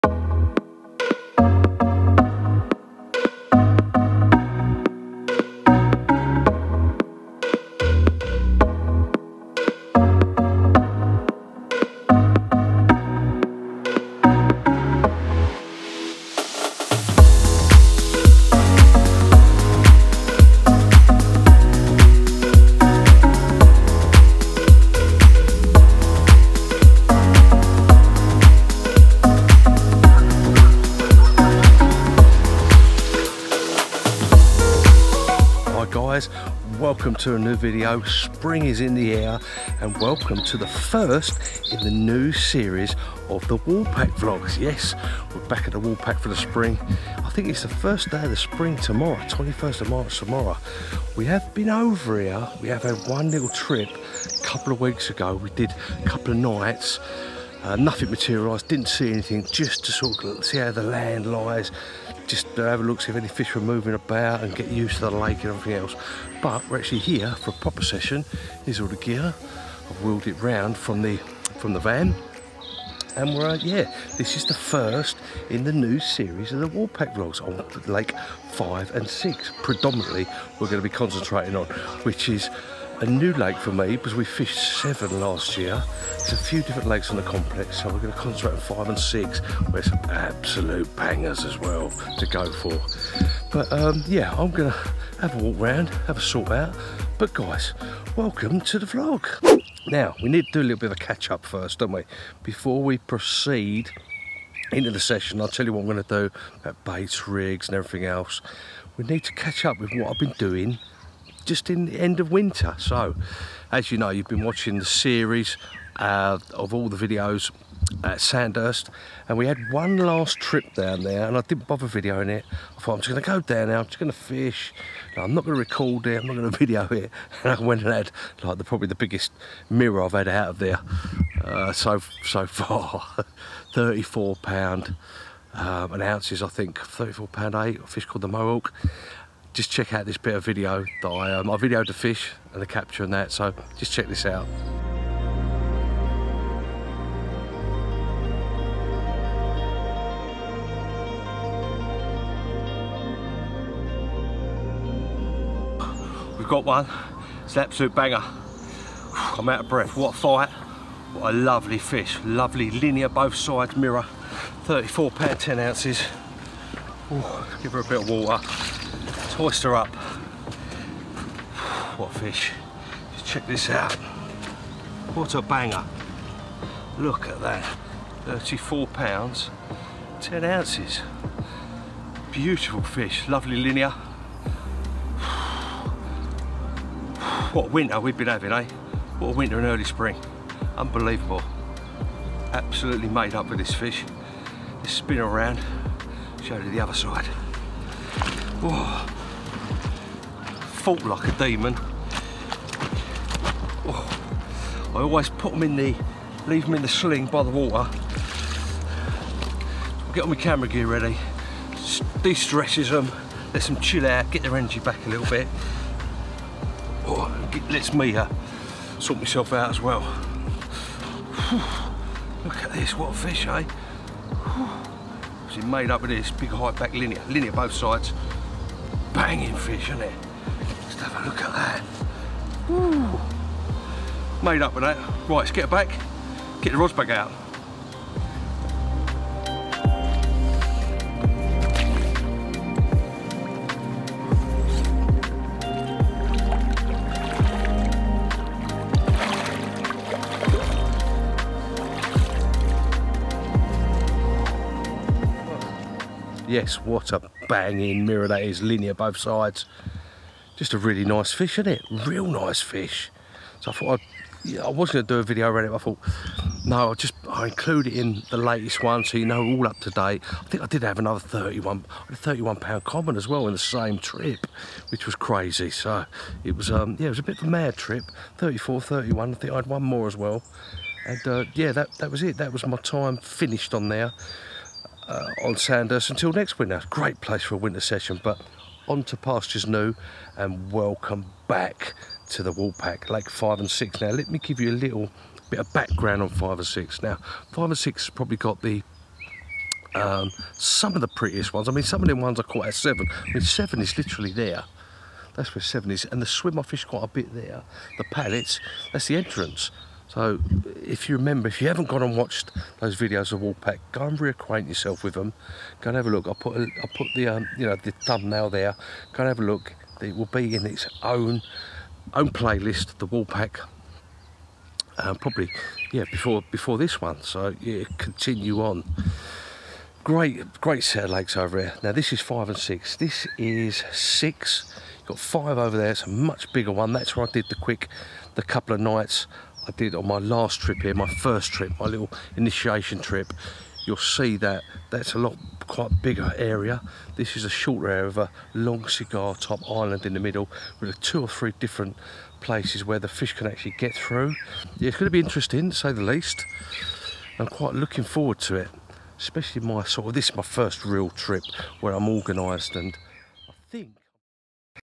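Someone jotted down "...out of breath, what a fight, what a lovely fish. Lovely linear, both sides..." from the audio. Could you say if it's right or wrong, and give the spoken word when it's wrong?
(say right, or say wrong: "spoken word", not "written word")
right.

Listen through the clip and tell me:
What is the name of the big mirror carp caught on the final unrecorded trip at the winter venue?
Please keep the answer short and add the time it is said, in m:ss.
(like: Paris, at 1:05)
The Mohawk, at 2:18.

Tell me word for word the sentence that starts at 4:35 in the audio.
So it was, um, yeah, it was a bit of a mad trip.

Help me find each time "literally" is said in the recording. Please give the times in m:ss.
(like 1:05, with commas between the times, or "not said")
5:03.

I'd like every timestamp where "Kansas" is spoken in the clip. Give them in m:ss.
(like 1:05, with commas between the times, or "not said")
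not said.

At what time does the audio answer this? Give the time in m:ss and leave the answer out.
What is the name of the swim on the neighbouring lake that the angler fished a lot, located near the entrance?
5:07.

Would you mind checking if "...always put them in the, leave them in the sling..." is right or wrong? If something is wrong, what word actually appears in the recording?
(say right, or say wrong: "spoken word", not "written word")
right.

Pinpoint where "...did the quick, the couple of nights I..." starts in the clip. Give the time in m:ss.
5:37.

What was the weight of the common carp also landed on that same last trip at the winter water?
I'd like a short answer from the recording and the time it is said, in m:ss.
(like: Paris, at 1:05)
31 pounds, at 4:32.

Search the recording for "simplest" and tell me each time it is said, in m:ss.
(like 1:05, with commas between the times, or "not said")
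not said.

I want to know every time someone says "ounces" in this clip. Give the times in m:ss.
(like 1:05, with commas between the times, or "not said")
2:16, 2:45, 3:00.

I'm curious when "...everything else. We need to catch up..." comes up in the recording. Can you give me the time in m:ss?
1:47.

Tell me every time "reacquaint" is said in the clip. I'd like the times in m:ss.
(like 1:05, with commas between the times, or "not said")
5:14.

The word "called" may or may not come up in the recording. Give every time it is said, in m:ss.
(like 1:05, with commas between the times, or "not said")
2:18.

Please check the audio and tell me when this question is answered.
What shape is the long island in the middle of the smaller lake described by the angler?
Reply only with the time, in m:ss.
5:48.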